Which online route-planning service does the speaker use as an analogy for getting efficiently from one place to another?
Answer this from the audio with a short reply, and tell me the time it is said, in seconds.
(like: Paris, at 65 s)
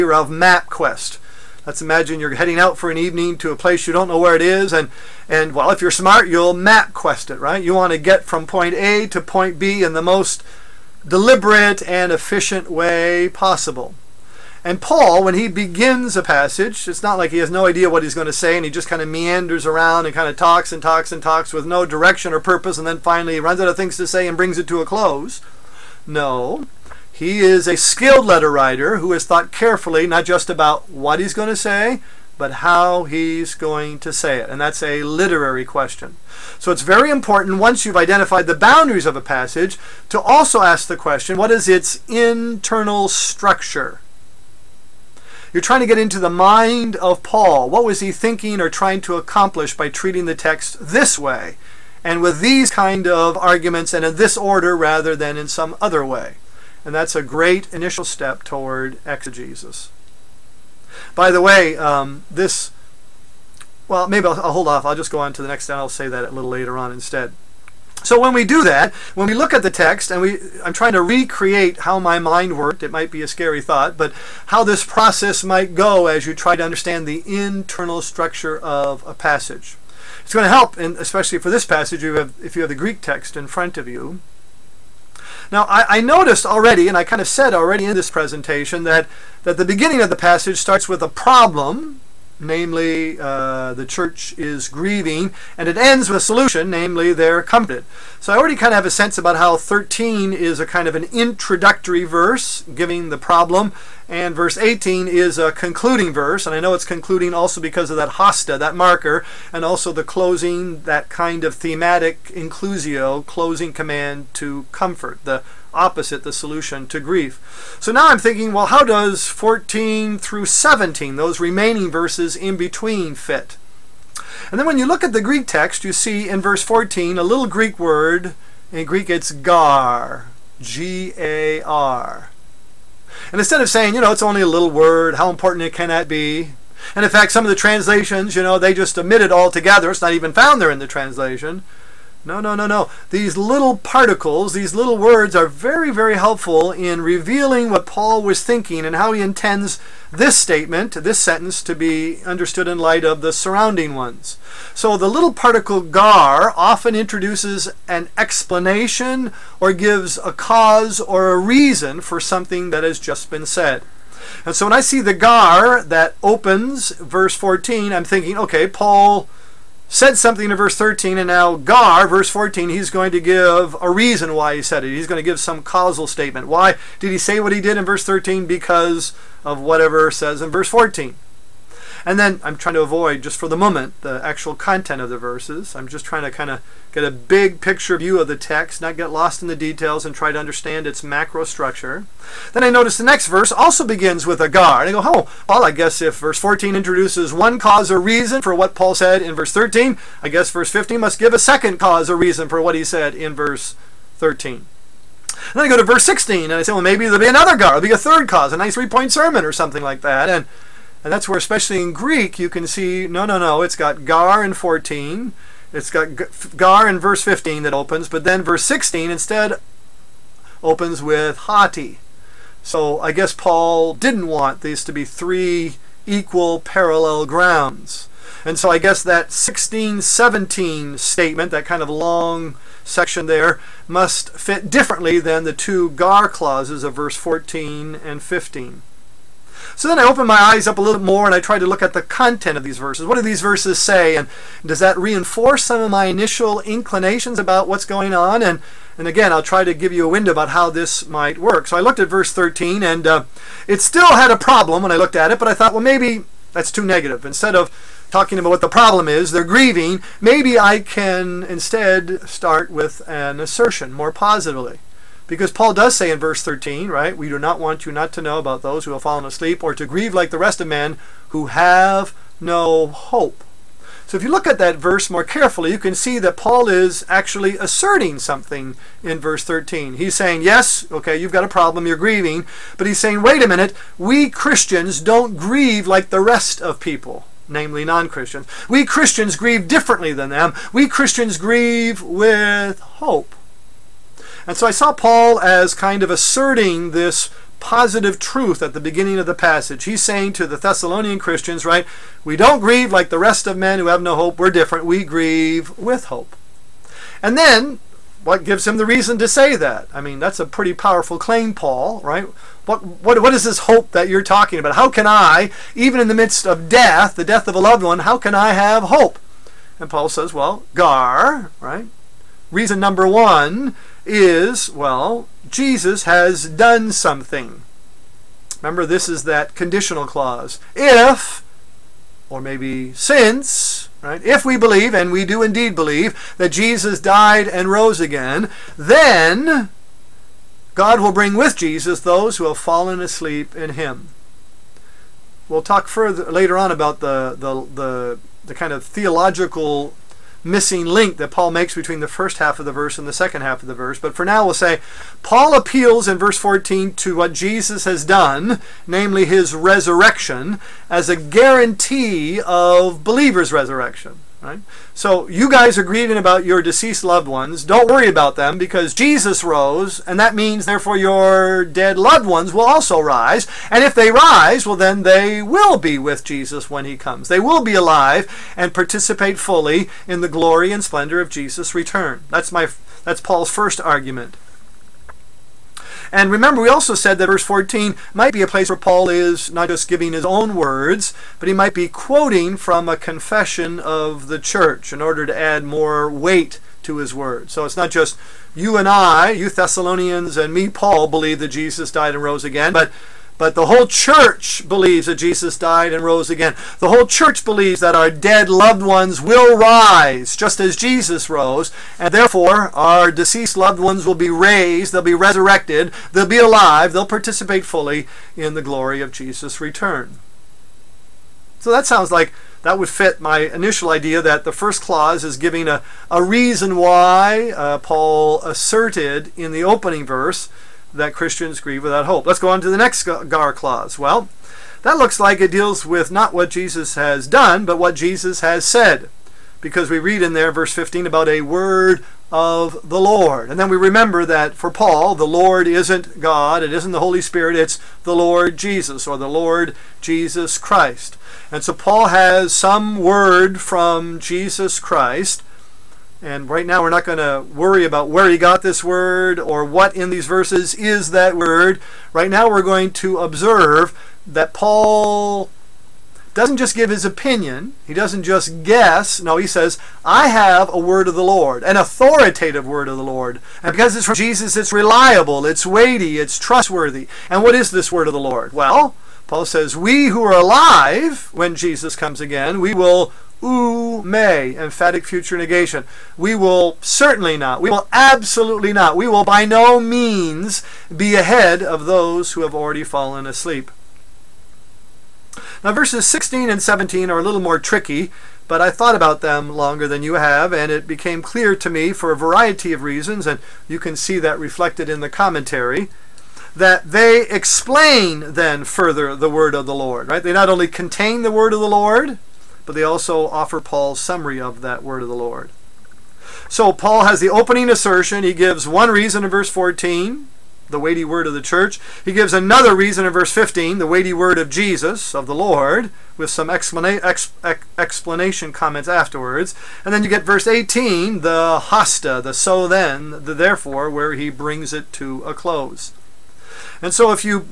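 MapQuest, at 0 s.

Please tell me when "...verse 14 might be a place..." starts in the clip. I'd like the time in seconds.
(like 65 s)
387 s.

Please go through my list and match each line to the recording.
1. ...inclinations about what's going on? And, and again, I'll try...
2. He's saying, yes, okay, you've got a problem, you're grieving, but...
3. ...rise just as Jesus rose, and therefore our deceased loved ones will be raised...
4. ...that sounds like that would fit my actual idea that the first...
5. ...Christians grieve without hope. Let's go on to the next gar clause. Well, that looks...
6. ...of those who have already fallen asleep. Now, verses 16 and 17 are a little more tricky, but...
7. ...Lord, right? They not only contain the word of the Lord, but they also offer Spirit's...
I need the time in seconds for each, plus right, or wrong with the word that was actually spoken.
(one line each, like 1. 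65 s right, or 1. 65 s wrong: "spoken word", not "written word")
1. 246 s right
2. 279 s right
3. 409 s right
4. 421 s wrong: "initial", not "actual"
5. 431 s right
6. 491 s right
7. 509 s wrong: "Paul", not "Spirit".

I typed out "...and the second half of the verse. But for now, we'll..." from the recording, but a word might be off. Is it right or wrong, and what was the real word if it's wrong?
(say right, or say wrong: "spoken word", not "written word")
right.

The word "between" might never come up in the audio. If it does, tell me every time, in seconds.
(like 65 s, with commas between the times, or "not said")
122 s, 351 s.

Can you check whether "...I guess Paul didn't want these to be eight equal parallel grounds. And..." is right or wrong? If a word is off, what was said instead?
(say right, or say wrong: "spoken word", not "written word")
wrong: "three", not "eight".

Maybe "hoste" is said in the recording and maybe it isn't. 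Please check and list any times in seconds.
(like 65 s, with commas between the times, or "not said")
108 s, 531 s.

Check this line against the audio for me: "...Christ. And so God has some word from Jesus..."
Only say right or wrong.
wrong.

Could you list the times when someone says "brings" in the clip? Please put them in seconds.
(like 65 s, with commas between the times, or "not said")
24 s, 341 s, 534 s.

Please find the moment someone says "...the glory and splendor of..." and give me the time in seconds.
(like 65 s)
380 s.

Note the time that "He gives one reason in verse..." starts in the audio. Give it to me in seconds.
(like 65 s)
518 s.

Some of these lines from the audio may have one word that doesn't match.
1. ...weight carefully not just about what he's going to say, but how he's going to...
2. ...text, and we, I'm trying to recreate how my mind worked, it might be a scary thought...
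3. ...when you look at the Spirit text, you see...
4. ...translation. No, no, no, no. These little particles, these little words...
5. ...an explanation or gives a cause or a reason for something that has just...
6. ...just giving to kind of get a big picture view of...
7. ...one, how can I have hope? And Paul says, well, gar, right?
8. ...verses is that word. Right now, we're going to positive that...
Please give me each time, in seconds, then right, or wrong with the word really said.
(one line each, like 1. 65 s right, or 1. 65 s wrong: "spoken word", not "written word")
1. 29 s wrong: "thought", not "weight"
2. 69 s right
3. 124 s wrong: "Greek", not "Spirit"
4. 140 s right
5. 157 s right
6. 185 s wrong: "trying", not "giving"
7. 317 s right
8. 460 s wrong: "observe", not "positive".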